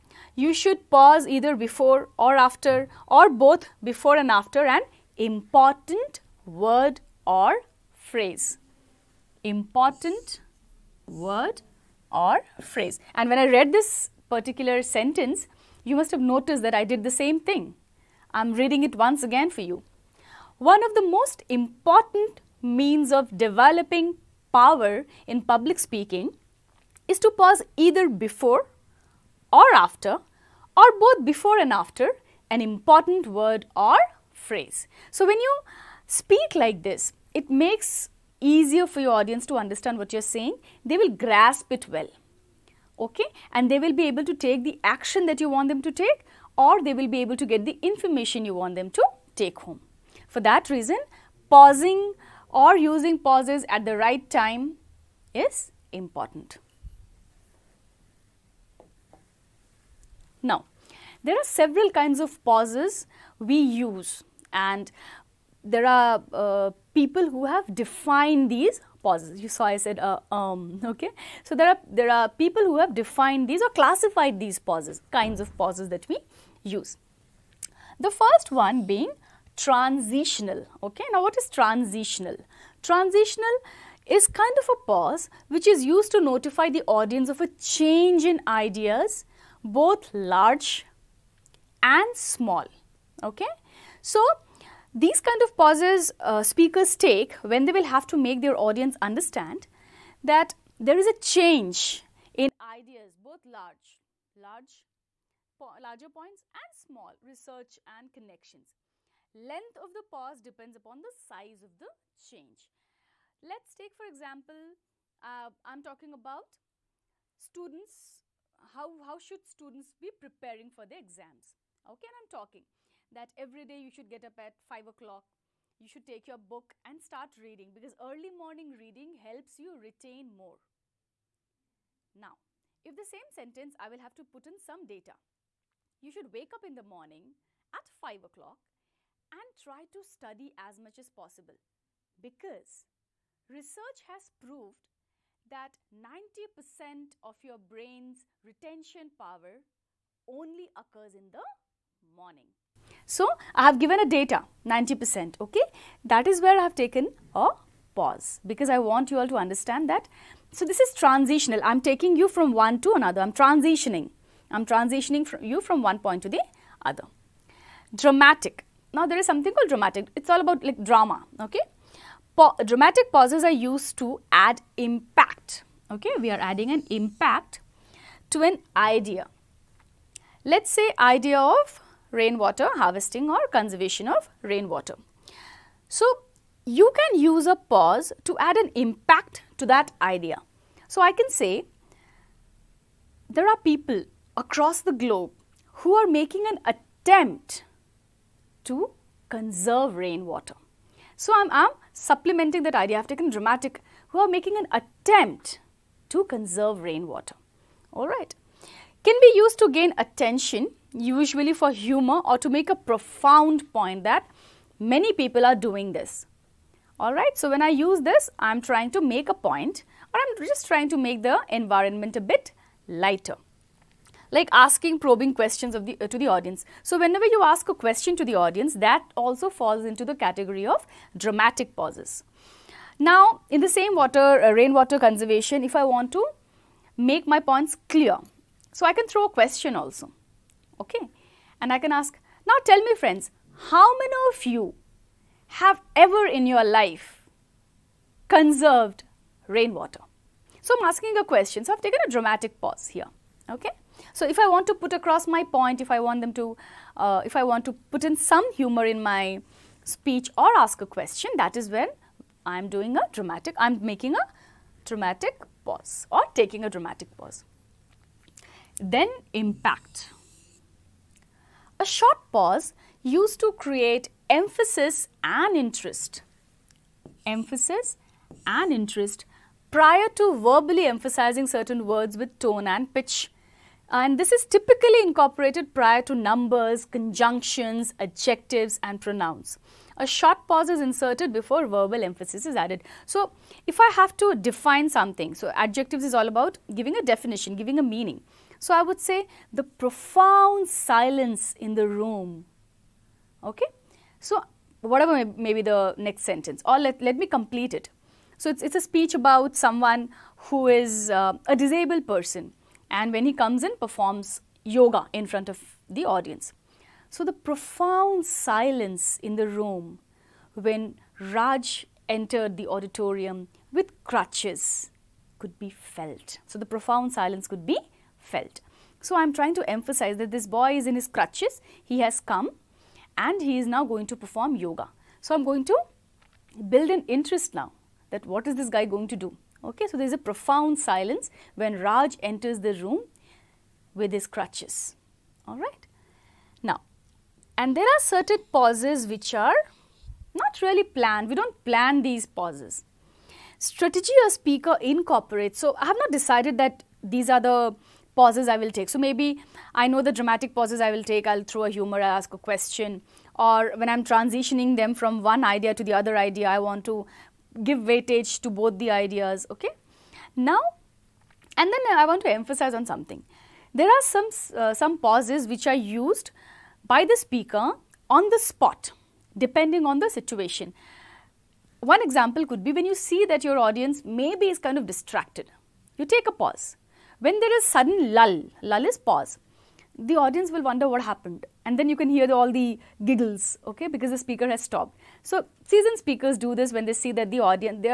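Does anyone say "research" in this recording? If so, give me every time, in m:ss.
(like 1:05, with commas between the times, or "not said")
1:47, 2:23.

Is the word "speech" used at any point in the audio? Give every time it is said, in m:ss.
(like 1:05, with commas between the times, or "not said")
4:19, 5:08.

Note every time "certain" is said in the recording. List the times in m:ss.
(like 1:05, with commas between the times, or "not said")
4:41, 5:47.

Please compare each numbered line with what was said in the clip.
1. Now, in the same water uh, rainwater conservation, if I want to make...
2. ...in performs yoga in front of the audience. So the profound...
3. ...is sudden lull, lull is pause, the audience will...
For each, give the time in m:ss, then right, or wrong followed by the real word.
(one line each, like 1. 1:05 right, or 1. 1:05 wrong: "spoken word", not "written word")
1. 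3:52 right
2. 5:13 right
3. 6:27 right.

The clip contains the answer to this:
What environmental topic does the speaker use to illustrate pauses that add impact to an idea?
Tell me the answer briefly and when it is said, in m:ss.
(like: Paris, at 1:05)
Rainwater harvesting, at 3:02.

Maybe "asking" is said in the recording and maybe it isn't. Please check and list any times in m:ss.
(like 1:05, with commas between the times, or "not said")
3:44, 4:10.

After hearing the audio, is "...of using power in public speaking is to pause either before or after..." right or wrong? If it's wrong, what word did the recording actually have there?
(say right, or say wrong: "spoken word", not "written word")
wrong: "developing", not "using".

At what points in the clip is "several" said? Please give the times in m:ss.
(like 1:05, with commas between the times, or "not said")
1:01.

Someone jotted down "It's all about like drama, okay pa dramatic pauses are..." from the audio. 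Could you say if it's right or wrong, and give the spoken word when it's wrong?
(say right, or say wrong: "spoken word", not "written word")
right.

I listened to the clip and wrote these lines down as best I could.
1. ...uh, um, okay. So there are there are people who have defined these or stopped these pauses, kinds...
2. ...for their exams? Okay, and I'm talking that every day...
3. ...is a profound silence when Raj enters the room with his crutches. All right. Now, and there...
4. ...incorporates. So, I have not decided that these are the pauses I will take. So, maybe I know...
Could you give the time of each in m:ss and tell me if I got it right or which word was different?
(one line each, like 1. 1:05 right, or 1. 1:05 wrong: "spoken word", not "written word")
1. 1:09 wrong: "classified", not "stopped"
2. 2:00 right
3. 5:40 right
4. 5:54 right.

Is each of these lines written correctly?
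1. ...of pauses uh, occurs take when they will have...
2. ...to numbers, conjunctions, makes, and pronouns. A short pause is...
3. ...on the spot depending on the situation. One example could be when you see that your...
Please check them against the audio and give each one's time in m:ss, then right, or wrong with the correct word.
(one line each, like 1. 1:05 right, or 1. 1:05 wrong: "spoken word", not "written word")
1. 1:35 wrong: "speakers", not "occurs"
2. 4:46 wrong: "adjectives", not "makes"
3. 6:18 right.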